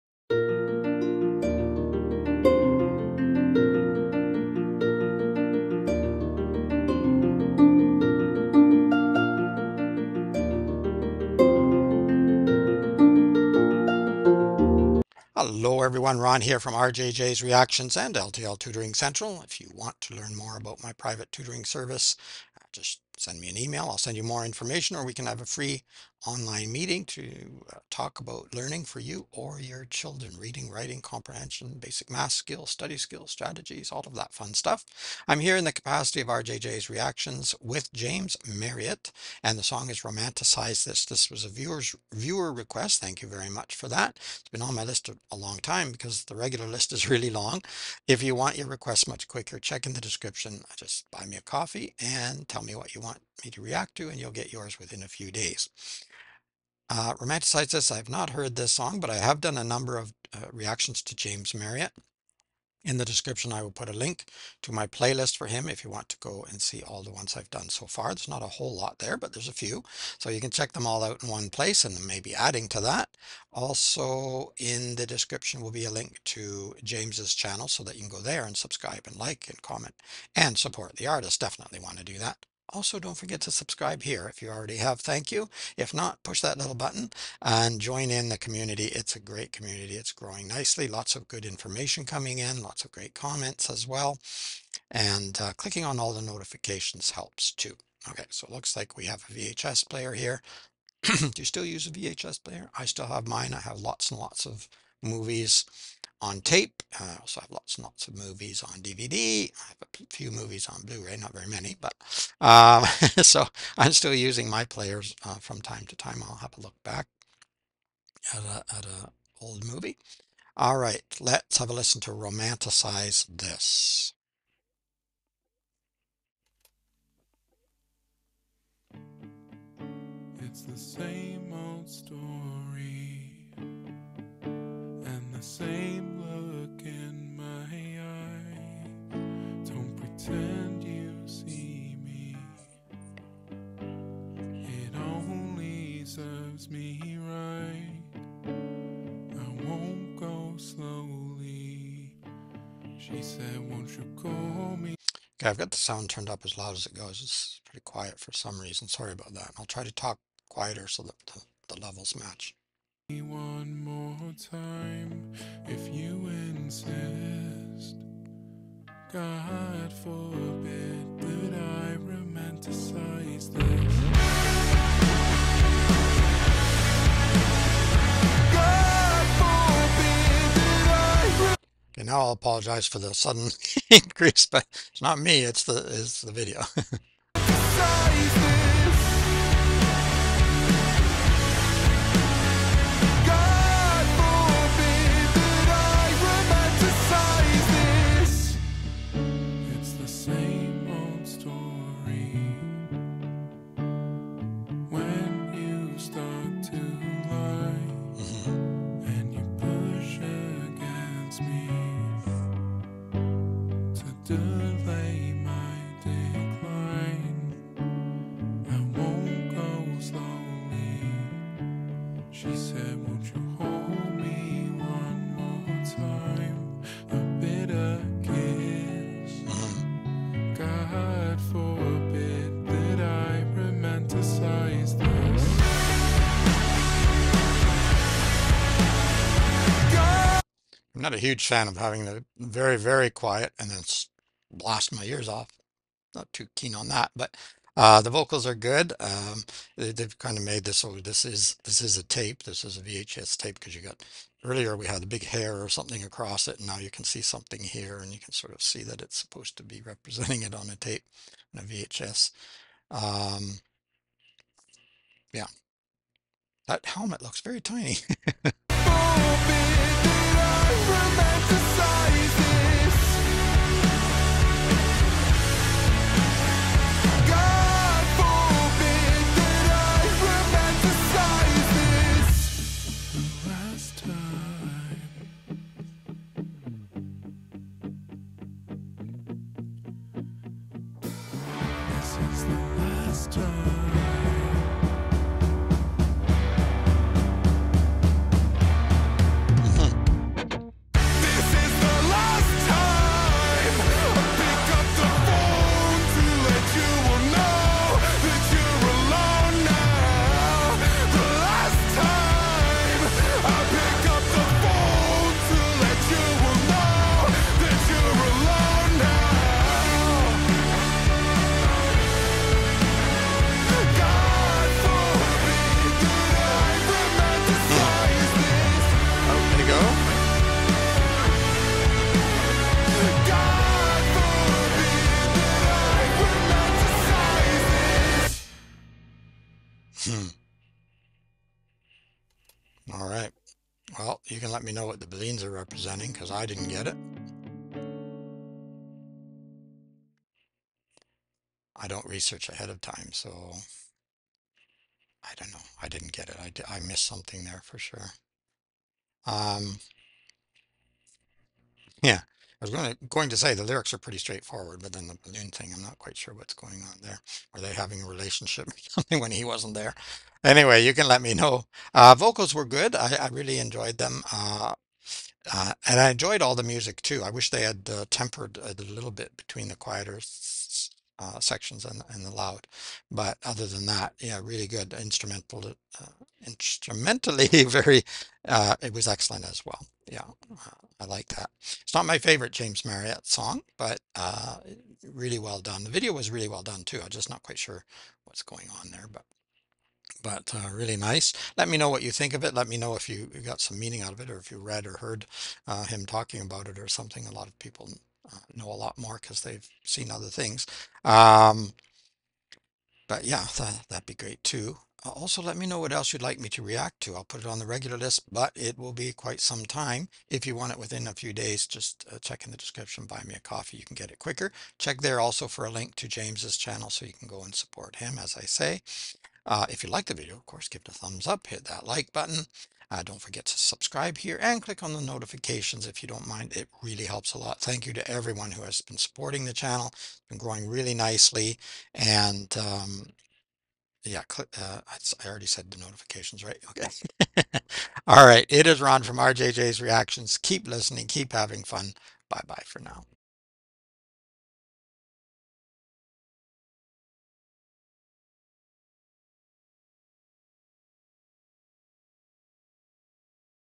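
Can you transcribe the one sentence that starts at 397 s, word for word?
I'm just not quite sure what's going on there, but but uh, really nice.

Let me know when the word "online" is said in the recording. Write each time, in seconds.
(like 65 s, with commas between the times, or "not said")
26 s.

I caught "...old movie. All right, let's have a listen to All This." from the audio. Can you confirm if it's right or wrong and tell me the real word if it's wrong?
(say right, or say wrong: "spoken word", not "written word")
wrong: "Romanticize", not "All".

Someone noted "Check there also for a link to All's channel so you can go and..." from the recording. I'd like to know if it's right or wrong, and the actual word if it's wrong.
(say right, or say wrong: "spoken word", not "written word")
wrong: "James", not "All".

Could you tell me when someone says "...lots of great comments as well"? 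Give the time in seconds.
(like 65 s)
92 s.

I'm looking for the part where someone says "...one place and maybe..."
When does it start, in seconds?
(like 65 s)
71 s.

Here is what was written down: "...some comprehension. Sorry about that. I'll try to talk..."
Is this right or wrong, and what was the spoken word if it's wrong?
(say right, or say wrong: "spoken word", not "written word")
wrong: "reason", not "comprehension".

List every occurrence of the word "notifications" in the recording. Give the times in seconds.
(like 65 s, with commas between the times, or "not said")
96 s, 434 s, 445 s.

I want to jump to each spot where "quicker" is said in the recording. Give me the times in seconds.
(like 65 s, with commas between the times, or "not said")
49 s, 424 s.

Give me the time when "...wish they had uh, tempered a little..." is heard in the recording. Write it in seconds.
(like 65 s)
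377 s.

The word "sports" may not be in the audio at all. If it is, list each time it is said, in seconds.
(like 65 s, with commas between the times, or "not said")
not said.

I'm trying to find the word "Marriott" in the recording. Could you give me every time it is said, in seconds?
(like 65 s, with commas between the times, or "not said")
38 s, 61 s, 392 s.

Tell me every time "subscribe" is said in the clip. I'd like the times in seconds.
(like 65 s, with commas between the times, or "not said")
78 s, 83 s, 433 s.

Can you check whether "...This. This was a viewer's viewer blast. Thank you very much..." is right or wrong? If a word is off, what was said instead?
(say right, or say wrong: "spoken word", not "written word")
wrong: "request", not "blast".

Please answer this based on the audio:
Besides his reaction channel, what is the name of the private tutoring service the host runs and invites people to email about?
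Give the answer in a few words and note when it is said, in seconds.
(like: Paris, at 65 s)
LTL Tutoring Central, at 18 s.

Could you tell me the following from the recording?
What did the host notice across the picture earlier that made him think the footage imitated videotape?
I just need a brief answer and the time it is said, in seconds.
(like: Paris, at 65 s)
A big hair, at 255 s.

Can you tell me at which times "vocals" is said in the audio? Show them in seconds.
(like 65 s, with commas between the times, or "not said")
248 s, 372 s.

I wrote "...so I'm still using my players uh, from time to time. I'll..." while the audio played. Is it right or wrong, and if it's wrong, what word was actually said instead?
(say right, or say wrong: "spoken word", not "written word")
right.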